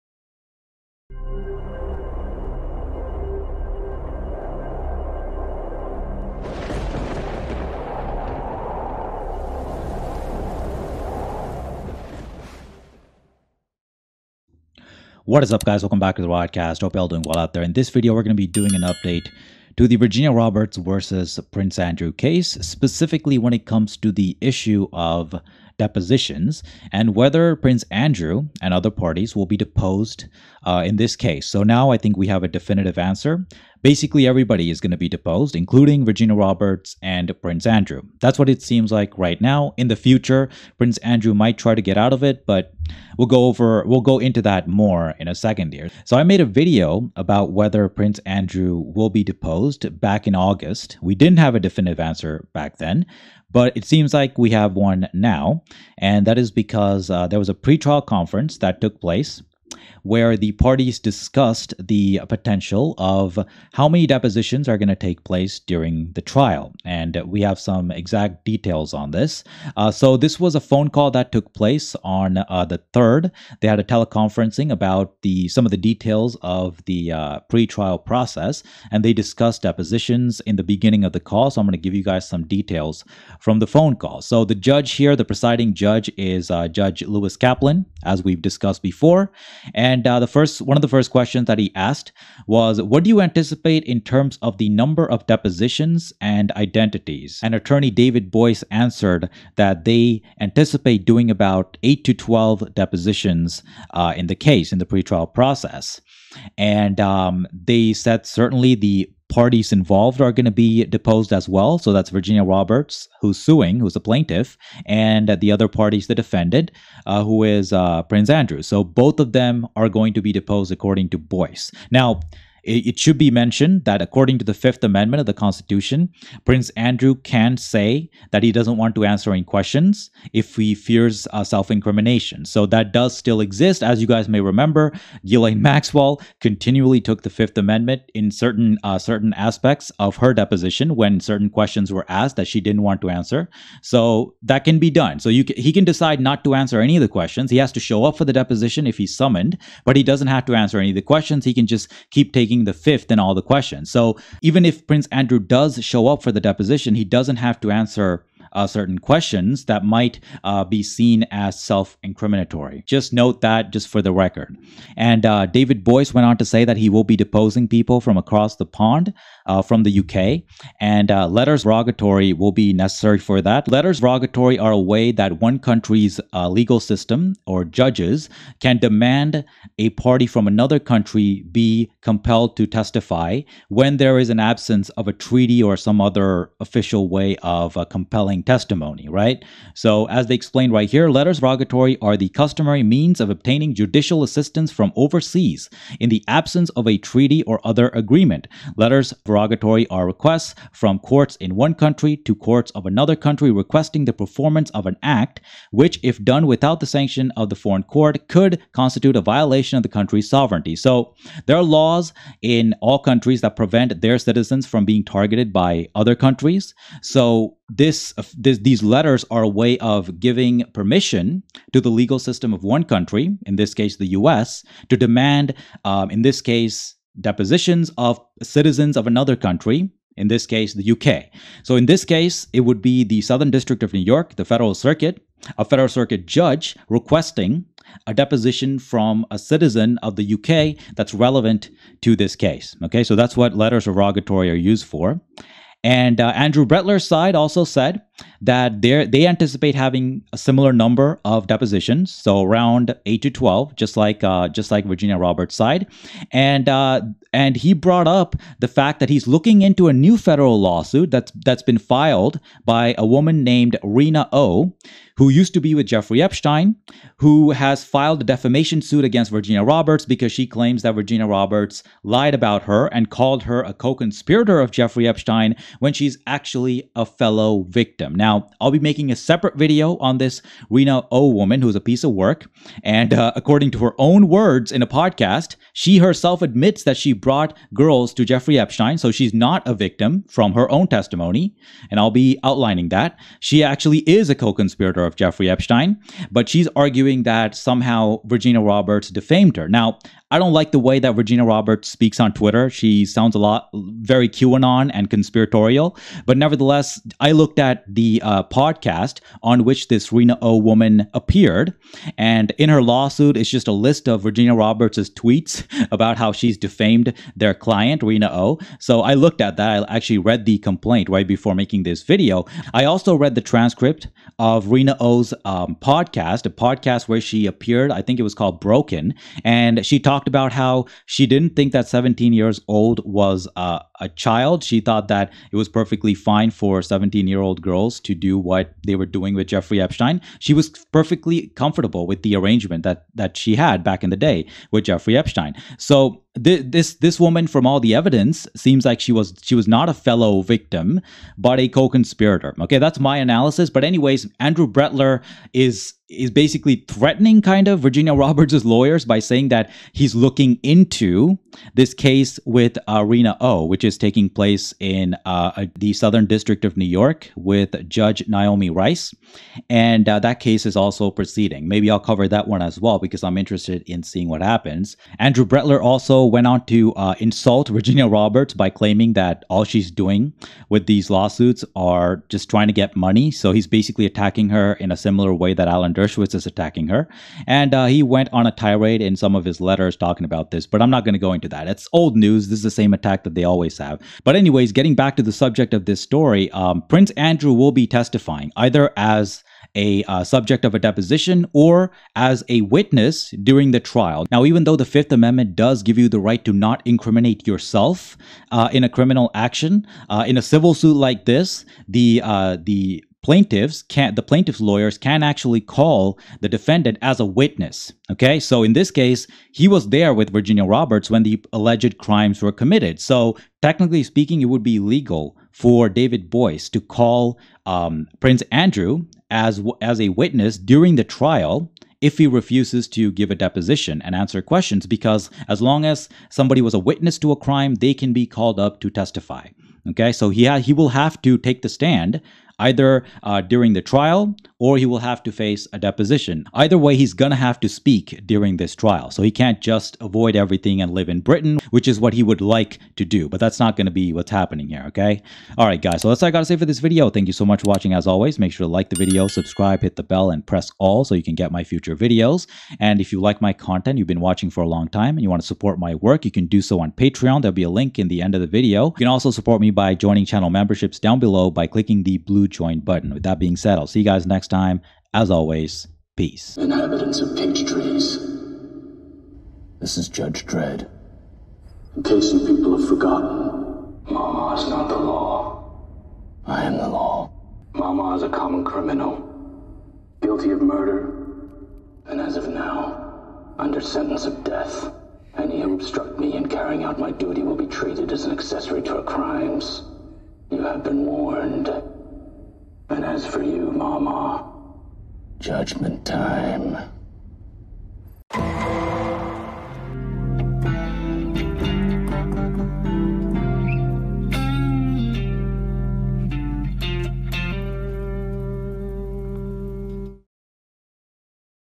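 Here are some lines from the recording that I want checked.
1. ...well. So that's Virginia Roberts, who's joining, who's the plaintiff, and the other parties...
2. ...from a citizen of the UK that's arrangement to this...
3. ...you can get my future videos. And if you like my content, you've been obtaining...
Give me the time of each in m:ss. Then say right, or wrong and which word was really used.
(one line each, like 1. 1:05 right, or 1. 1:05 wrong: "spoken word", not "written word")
1. 1:51 wrong: "suing", not "joining"
2. 3:58 wrong: "relevant", not "arrangement"
3. 7:41 wrong: "watching", not "obtaining".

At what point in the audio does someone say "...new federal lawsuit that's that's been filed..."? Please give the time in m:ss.
4:19.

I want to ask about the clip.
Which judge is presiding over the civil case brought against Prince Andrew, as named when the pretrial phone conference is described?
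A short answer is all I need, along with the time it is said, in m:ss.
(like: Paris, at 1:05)
Lewis Kaplan, at 1:26.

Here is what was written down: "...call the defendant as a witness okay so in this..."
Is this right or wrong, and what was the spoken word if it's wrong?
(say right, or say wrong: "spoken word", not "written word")
right.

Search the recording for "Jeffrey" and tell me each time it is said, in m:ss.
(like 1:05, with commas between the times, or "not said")
4:25, 4:34, 4:48, 4:55, 5:39, 5:44.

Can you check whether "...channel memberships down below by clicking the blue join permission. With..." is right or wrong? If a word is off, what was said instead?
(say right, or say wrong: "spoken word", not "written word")
wrong: "button", not "permission".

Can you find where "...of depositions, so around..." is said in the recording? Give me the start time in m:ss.
4:11.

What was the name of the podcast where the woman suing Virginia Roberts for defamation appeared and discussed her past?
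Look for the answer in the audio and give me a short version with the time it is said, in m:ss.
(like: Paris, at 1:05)
Broken, at 5:28.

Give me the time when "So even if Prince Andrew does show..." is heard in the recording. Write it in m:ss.
2:33.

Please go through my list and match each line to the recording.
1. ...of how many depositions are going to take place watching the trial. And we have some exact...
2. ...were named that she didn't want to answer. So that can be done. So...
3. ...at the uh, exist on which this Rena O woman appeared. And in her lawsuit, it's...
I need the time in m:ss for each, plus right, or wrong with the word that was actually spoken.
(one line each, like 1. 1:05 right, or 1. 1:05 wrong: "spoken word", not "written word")
1. 1:02 wrong: "during", not "watching"
2. 2:21 wrong: "asked", not "named"
3. 5:07 wrong: "podcast", not "exist".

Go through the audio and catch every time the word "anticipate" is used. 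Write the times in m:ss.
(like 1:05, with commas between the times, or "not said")
1:33, 1:40, 4:09.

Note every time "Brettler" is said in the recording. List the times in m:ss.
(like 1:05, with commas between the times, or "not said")
4:06, 5:54, 6:15.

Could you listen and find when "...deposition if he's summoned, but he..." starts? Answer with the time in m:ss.
2:28.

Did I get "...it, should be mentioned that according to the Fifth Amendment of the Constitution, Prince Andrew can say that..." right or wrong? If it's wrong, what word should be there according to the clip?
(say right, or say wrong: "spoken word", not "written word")
right.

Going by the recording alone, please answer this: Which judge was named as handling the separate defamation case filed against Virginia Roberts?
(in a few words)
Naomi Rice.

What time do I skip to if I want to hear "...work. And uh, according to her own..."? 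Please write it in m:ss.
4:42.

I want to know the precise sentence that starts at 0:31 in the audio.
So now I think we have a definitive answer.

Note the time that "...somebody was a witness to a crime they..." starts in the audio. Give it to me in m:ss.
7:16.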